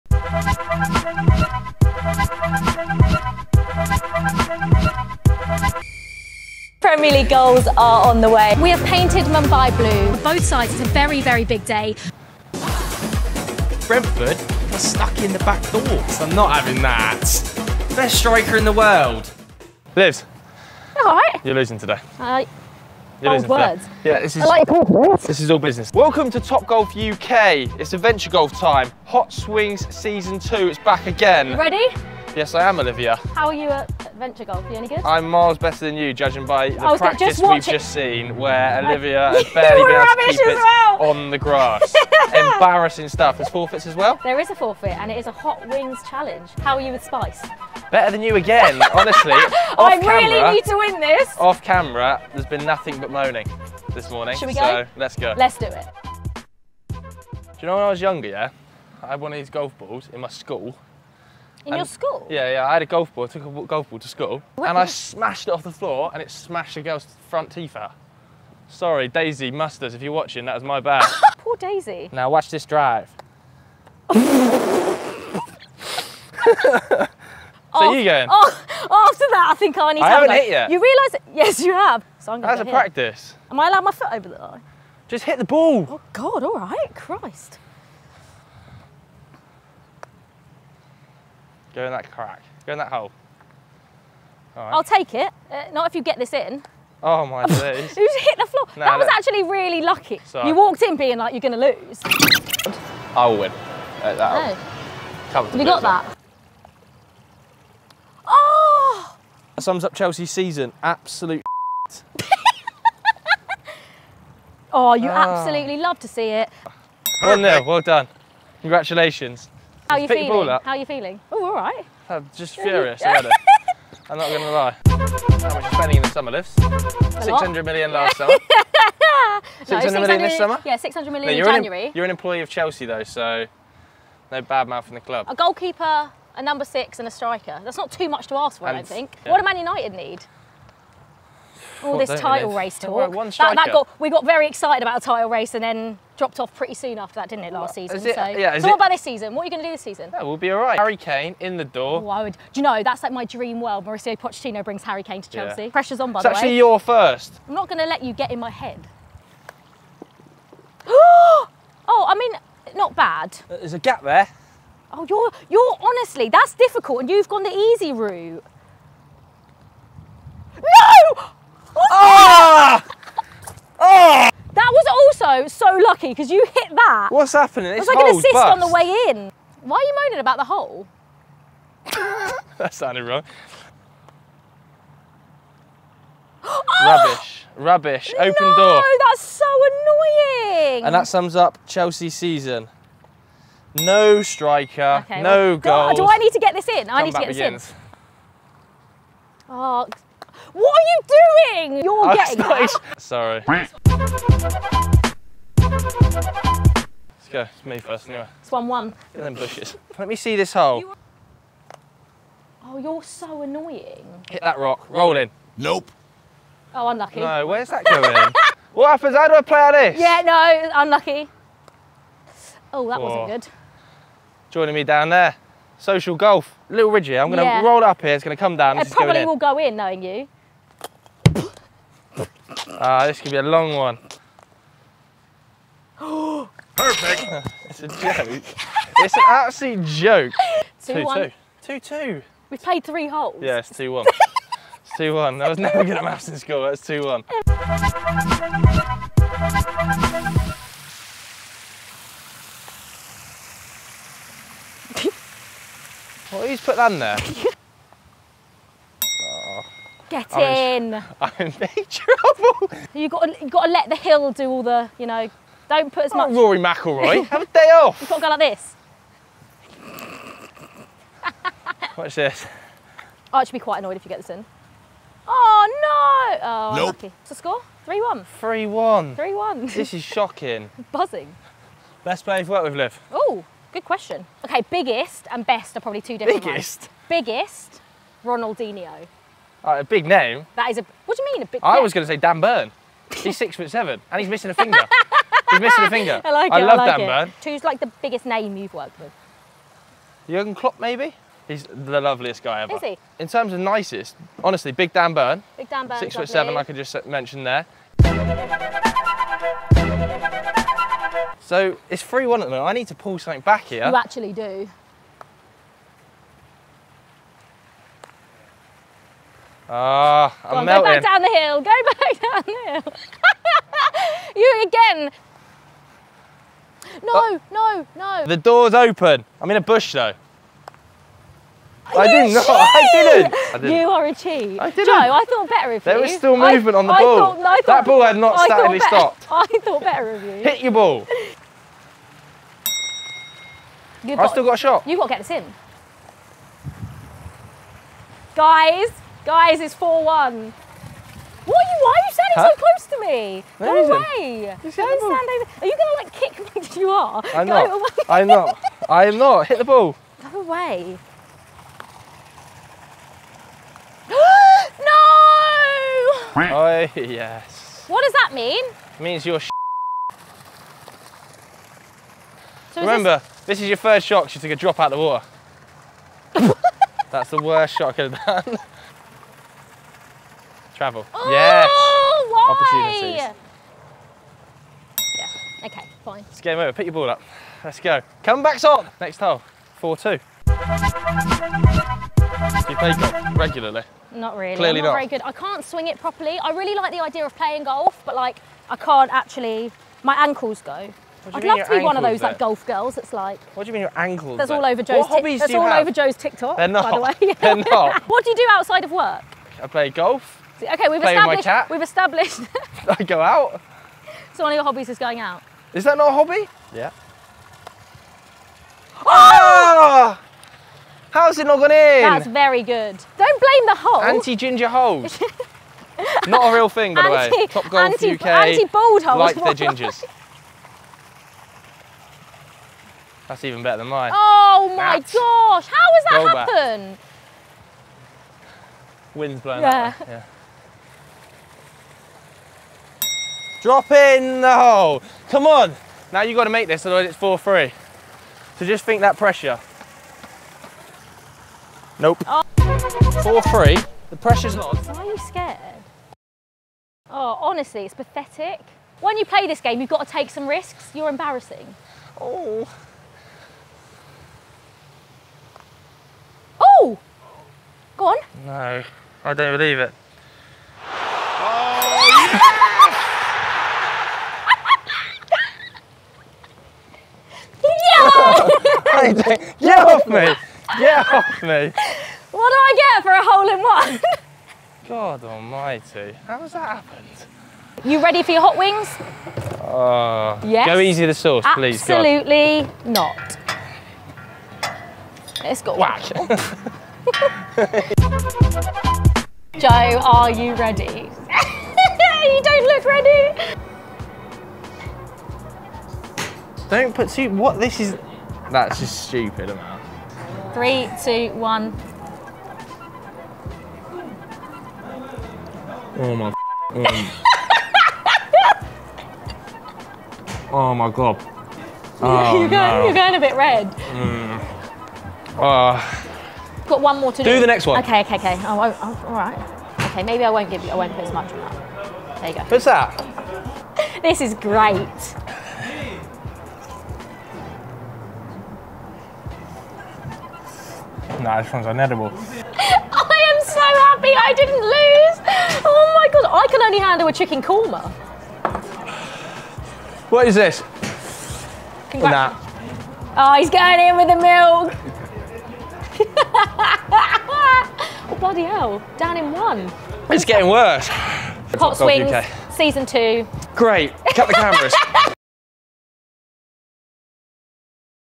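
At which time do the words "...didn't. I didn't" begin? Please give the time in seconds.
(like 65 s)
332 s.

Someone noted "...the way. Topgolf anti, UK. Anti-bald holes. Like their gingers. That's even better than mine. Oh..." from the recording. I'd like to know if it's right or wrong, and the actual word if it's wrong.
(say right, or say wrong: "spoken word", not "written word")
right.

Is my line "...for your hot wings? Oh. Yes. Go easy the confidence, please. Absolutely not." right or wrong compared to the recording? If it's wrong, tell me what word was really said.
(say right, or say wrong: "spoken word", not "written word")
wrong: "sauce", not "confidence".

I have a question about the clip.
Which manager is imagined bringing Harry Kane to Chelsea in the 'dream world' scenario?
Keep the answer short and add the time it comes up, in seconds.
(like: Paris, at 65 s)
Mauricio Pochettino, at 153 s.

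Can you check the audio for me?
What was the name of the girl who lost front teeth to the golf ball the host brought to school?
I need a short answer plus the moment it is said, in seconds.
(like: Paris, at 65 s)
Daisy Musters, at 69 s.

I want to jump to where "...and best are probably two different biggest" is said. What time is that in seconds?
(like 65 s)
285 s.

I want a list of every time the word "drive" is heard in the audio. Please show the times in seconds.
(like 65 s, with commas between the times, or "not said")
72 s.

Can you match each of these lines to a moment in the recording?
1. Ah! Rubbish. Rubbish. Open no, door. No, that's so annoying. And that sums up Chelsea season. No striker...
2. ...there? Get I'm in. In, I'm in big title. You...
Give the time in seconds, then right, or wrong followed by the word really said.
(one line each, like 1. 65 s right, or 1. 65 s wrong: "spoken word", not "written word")
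1. 186 s right
2. 256 s wrong: "trouble", not "title".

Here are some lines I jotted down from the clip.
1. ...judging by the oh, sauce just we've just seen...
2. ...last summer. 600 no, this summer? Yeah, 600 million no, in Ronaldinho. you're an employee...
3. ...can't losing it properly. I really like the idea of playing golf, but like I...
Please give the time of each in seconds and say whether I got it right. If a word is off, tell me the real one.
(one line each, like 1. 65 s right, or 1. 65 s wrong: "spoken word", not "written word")
1. 36 s wrong: "practice", not "sauce"
2. 127 s wrong: "January", not "Ronaldinho"
3. 395 s wrong: "swing", not "losing".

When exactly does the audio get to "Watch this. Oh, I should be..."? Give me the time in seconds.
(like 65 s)
271 s.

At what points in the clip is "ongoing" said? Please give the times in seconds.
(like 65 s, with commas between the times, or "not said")
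not said.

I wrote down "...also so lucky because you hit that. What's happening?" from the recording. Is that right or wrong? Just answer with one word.
right.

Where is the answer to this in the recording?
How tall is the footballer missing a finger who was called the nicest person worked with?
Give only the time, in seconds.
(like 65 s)
293 s.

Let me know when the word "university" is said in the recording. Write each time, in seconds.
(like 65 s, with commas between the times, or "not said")
not said.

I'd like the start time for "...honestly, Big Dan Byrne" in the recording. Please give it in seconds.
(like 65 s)
304 s.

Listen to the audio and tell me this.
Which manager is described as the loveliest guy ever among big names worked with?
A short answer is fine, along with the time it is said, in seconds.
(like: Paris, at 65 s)
Jurgen Klopp, at 300 s.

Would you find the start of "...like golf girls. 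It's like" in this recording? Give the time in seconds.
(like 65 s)
402 s.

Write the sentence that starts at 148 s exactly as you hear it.
It, so, yeah, so what about this season?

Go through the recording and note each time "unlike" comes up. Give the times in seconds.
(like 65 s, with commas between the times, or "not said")
not said.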